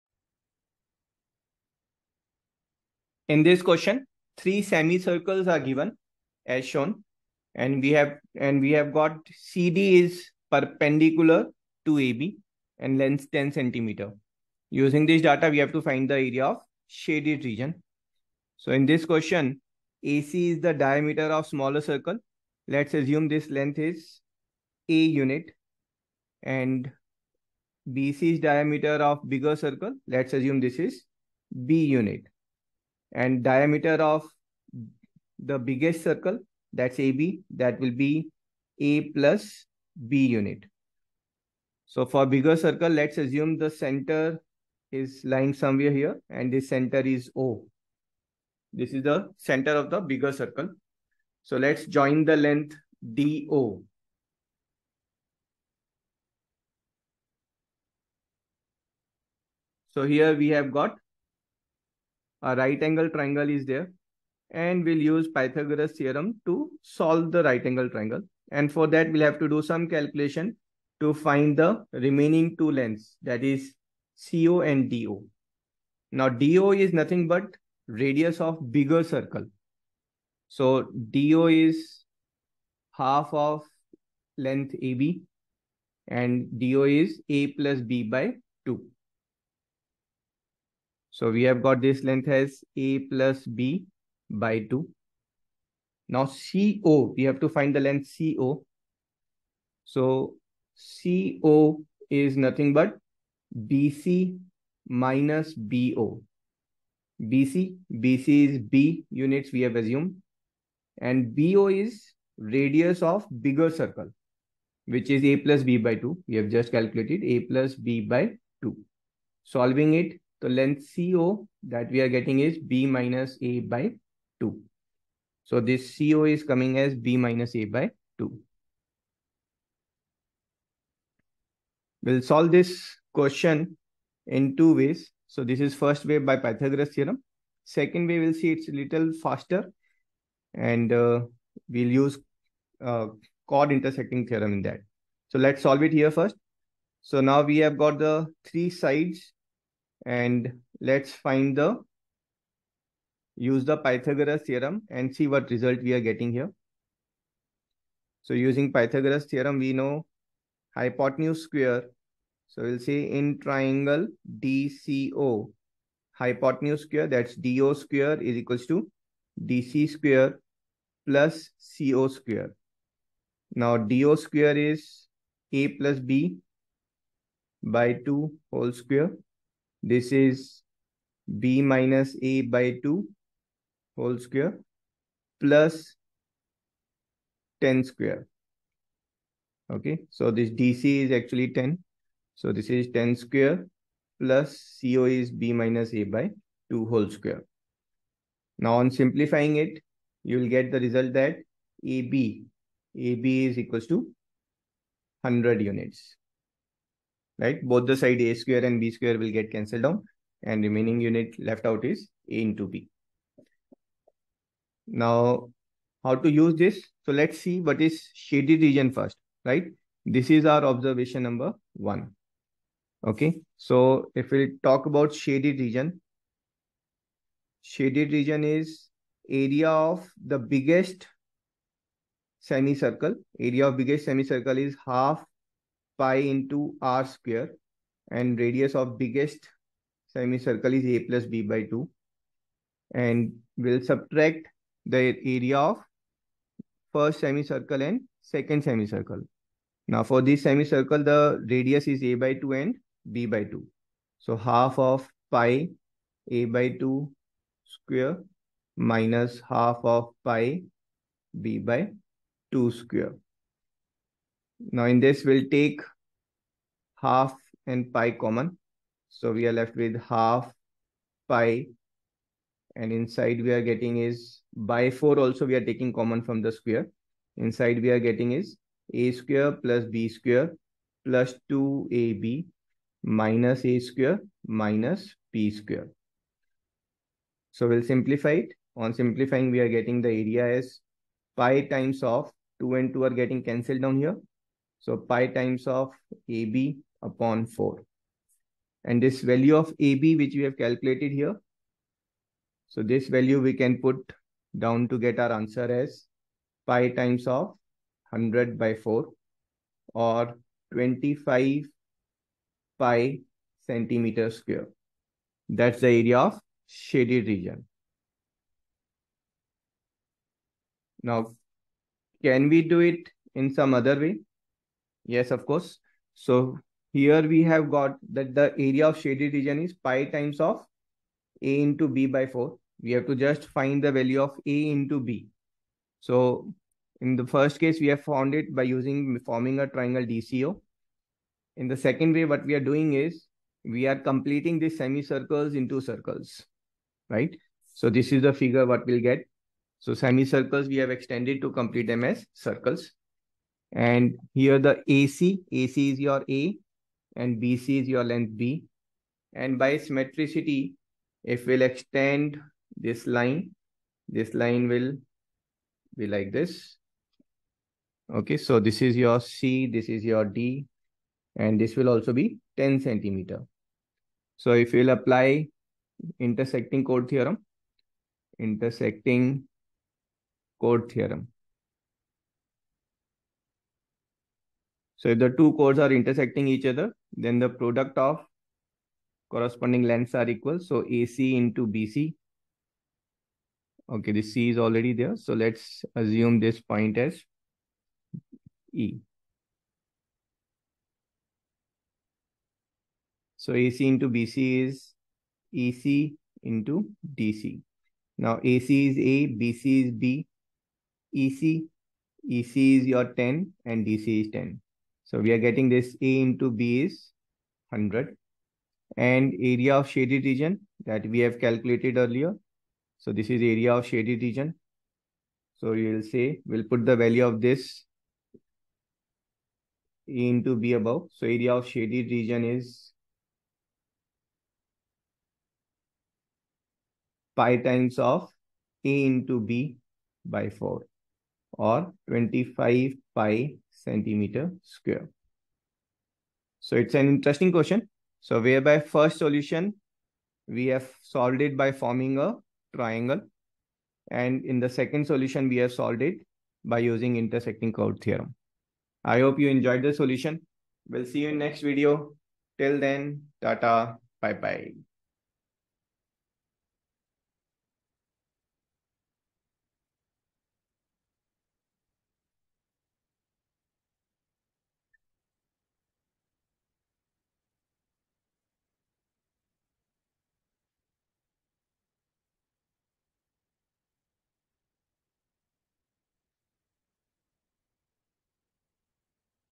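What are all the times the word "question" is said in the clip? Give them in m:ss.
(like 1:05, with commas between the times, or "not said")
0:03, 0:19, 2:13, 7:27.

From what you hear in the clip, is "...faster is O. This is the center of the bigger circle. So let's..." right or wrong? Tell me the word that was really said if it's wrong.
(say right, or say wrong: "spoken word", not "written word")
wrong: "center", not "faster".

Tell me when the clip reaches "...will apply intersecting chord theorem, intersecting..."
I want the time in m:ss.
6:14.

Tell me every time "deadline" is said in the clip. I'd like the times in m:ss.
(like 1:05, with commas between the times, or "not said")
not said.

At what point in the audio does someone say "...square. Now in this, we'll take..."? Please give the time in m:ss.
4:22.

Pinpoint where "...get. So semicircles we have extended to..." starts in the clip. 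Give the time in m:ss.
5:49.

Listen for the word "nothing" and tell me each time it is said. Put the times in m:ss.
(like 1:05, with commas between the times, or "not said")
1:16, 1:42.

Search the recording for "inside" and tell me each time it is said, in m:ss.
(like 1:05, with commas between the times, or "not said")
4:32, 4:37.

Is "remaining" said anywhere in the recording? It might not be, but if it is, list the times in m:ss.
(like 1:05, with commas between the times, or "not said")
1:11, 3:30.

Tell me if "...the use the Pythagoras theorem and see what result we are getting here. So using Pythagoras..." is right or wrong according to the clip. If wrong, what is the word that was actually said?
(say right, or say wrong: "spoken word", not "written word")
right.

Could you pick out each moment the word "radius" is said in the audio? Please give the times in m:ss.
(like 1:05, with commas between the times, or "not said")
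1:17, 1:52, 3:58, 4:11.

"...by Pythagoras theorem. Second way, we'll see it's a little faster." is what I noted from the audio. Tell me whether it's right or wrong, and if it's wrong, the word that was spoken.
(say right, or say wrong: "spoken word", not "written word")
right.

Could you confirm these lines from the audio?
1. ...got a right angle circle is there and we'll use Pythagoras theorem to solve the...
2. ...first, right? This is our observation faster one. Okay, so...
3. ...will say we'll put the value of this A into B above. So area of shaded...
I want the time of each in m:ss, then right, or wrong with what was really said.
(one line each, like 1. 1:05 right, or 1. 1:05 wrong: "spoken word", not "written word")
1. 1:00 wrong: "triangle", not "circle"
2. 3:38 wrong: "number", not "faster"
3. 7:05 right.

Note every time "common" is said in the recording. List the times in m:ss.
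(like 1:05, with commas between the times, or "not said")
4:28, 4:35.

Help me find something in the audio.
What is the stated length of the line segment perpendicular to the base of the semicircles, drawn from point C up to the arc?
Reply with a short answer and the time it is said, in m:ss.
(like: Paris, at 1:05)
10 centimeter, at 0:12.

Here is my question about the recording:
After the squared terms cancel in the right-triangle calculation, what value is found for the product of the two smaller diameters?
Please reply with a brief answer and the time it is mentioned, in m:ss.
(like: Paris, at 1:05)
100, at 3:22.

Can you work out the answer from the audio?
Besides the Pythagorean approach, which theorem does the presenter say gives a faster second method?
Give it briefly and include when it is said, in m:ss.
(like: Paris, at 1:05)
chord intersecting theorem, at 2:23.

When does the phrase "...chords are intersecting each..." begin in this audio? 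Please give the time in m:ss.
6:25.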